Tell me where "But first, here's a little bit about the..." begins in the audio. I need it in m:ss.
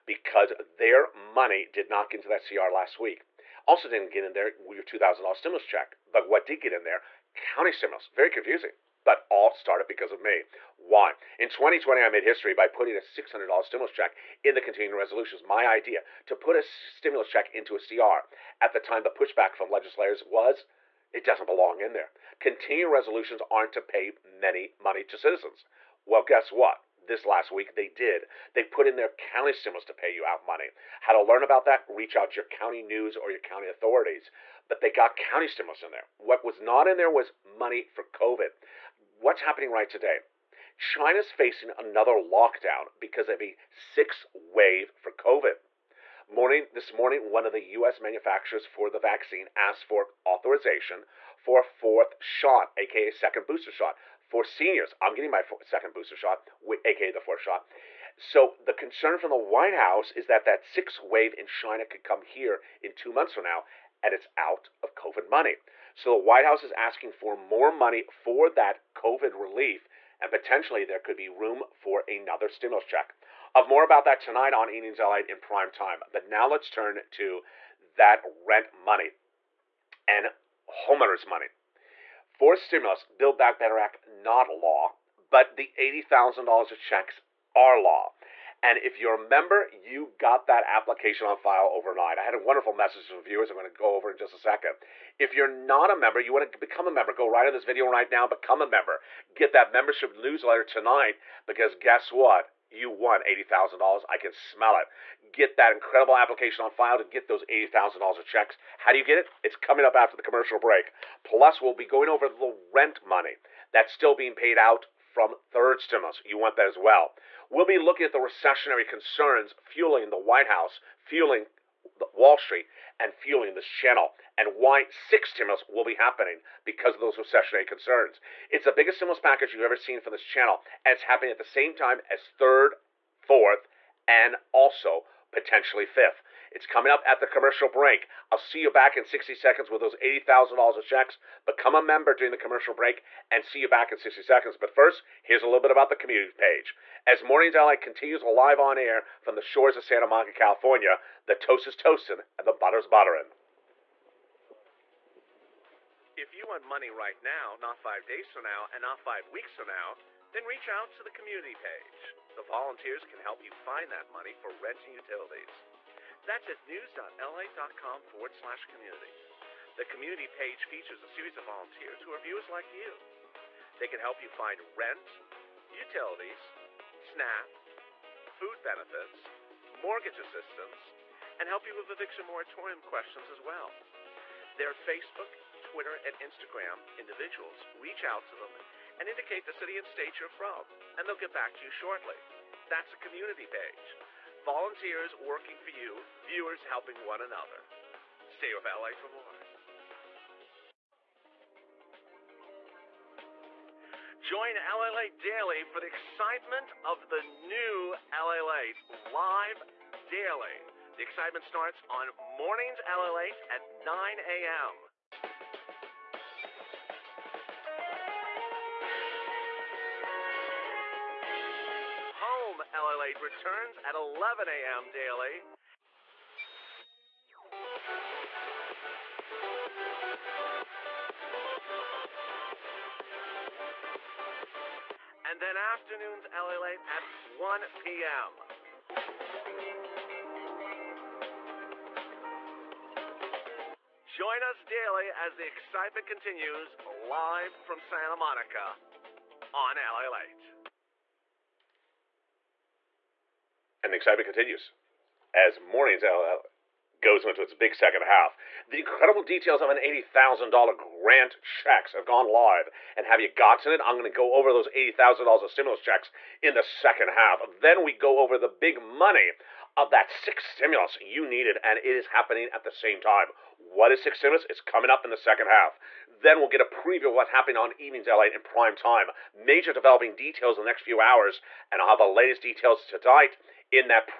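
2:24.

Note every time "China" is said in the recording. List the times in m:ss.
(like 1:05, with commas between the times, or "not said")
0:40, 1:01.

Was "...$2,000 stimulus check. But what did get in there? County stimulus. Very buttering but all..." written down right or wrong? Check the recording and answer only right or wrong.
wrong.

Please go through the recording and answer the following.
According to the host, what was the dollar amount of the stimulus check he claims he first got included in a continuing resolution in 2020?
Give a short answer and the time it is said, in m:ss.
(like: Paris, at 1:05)
$600, at 0:13.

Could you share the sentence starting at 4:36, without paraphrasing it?
Then we'll get a preview of what happened on Evenings LA in prime time.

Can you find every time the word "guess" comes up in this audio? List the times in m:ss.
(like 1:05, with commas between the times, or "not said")
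0:26, 1:41.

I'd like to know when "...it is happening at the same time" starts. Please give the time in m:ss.
4:31.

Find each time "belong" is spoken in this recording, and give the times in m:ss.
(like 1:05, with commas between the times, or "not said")
0:21.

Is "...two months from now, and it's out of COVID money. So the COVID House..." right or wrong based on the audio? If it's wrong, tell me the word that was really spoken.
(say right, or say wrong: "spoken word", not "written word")
wrong: "White", not "COVID".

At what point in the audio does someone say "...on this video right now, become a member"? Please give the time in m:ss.
1:37.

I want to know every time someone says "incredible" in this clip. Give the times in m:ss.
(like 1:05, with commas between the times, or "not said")
1:45, 4:18.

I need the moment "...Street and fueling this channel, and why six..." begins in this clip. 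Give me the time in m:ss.
2:02.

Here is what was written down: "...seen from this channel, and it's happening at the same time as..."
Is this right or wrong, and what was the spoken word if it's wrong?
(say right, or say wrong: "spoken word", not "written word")
right.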